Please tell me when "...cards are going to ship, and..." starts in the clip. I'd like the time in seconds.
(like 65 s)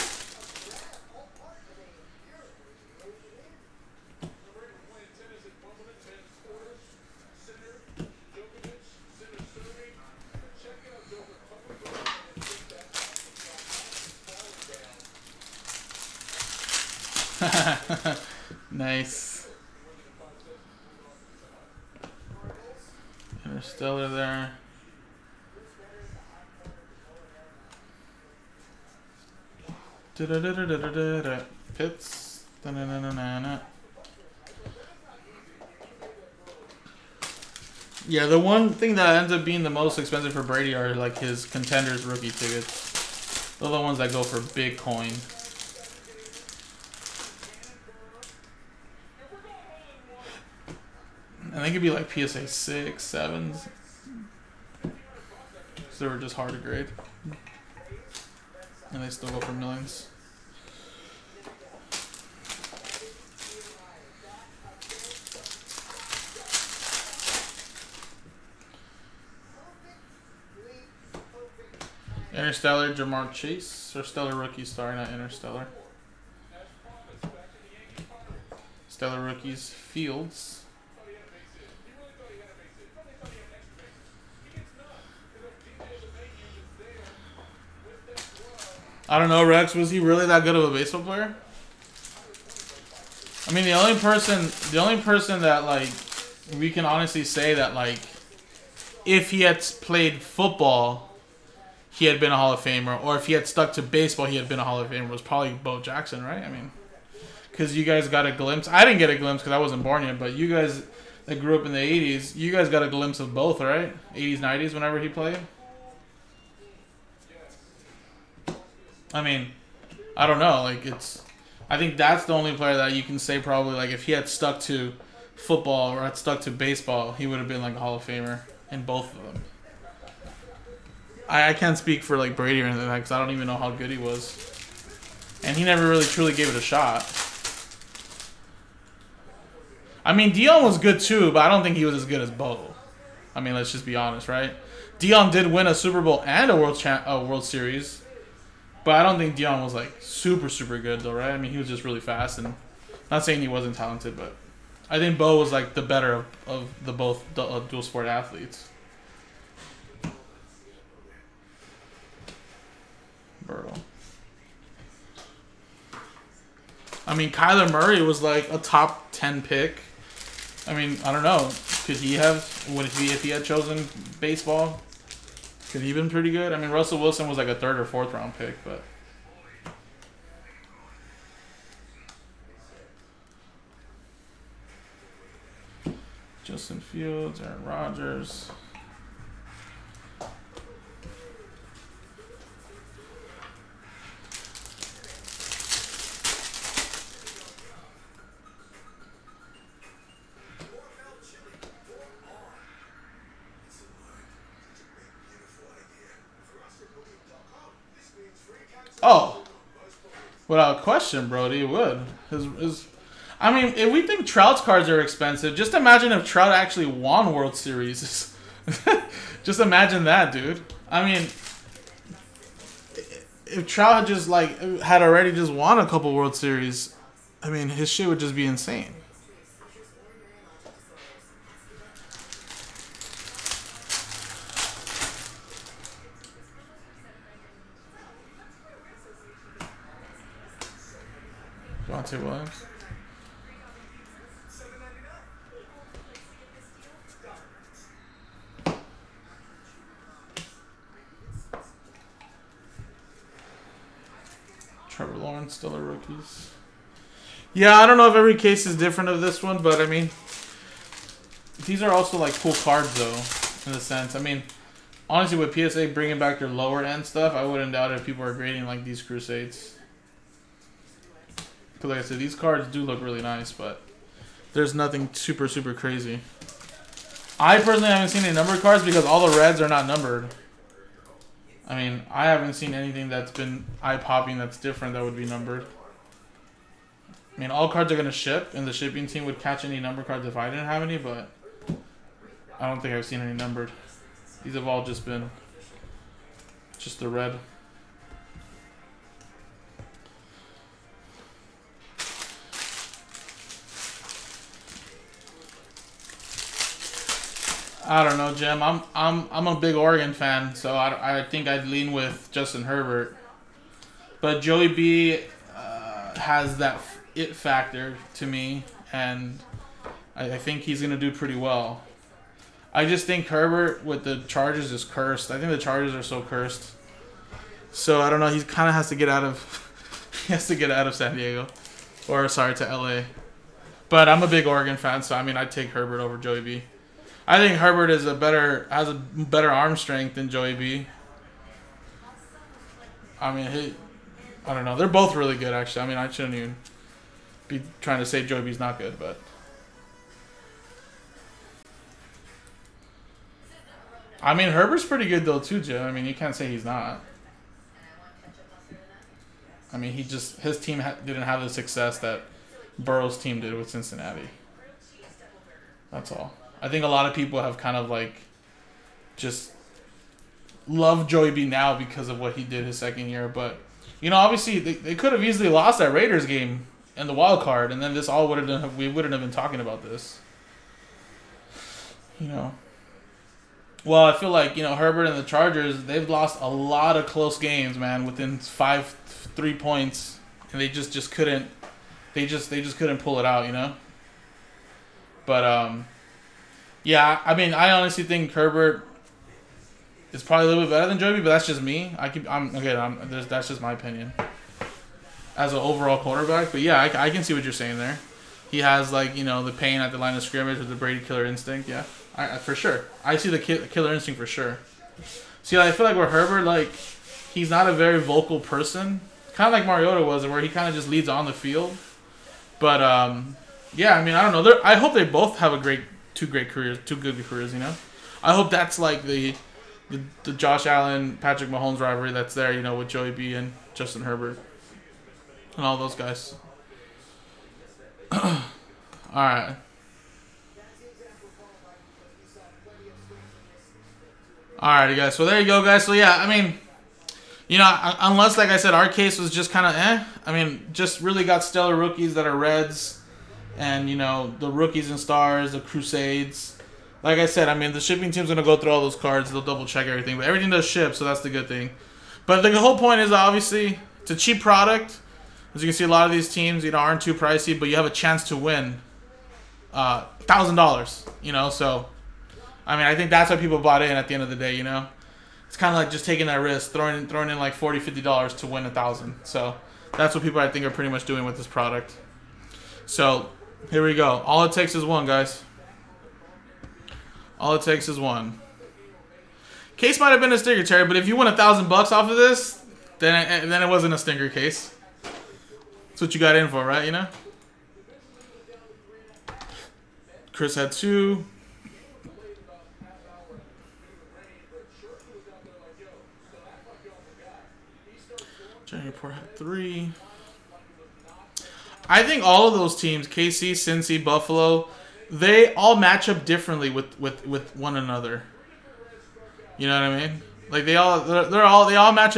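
287 s.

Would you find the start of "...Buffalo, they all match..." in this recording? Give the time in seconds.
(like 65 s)
514 s.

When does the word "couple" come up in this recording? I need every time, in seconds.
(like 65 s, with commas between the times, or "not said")
225 s.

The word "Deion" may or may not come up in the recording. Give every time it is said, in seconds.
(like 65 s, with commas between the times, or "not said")
140 s, 144 s, 149 s.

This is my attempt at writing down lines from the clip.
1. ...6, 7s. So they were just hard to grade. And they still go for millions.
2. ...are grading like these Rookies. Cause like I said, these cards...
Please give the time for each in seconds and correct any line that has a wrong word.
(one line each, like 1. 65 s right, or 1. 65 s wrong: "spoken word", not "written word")
1. 52 s right
2. 268 s wrong: "Crusades", not "Rookies".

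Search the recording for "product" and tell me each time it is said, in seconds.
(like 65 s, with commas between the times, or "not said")
464 s, 481 s.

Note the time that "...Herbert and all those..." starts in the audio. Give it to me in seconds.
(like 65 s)
434 s.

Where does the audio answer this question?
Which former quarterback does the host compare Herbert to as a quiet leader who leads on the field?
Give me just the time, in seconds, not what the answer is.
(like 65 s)
419 s.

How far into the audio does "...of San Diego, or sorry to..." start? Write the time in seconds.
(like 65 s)
330 s.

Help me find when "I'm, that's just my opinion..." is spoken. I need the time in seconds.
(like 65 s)
402 s.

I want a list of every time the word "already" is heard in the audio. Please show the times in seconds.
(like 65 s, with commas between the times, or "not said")
225 s.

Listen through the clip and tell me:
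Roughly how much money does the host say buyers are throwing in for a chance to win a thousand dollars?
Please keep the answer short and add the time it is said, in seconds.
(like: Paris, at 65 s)
$40, at 477 s.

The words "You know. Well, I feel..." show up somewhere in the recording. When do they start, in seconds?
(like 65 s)
382 s.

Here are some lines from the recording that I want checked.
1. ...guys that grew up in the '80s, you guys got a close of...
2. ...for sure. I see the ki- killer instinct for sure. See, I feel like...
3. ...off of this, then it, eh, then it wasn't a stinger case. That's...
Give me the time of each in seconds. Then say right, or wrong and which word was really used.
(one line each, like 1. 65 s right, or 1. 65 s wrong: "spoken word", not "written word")
1. 110 s wrong: "glimpse", not "close"
2. 412 s right
3. 491 s right.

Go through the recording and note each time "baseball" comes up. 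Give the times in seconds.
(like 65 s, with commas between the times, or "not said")
90 s, 103 s, 126 s, 174 s.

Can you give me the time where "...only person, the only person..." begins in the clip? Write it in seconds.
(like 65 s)
93 s.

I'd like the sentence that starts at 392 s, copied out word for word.
They just they just couldn't pull it out, you know.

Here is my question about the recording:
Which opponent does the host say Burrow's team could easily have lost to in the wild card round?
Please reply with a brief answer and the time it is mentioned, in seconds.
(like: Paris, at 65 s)
Raiders, at 375 s.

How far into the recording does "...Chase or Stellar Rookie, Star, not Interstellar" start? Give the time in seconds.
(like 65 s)
73 s.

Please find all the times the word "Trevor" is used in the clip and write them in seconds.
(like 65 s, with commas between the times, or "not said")
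254 s.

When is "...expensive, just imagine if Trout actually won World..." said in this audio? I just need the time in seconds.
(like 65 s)
214 s.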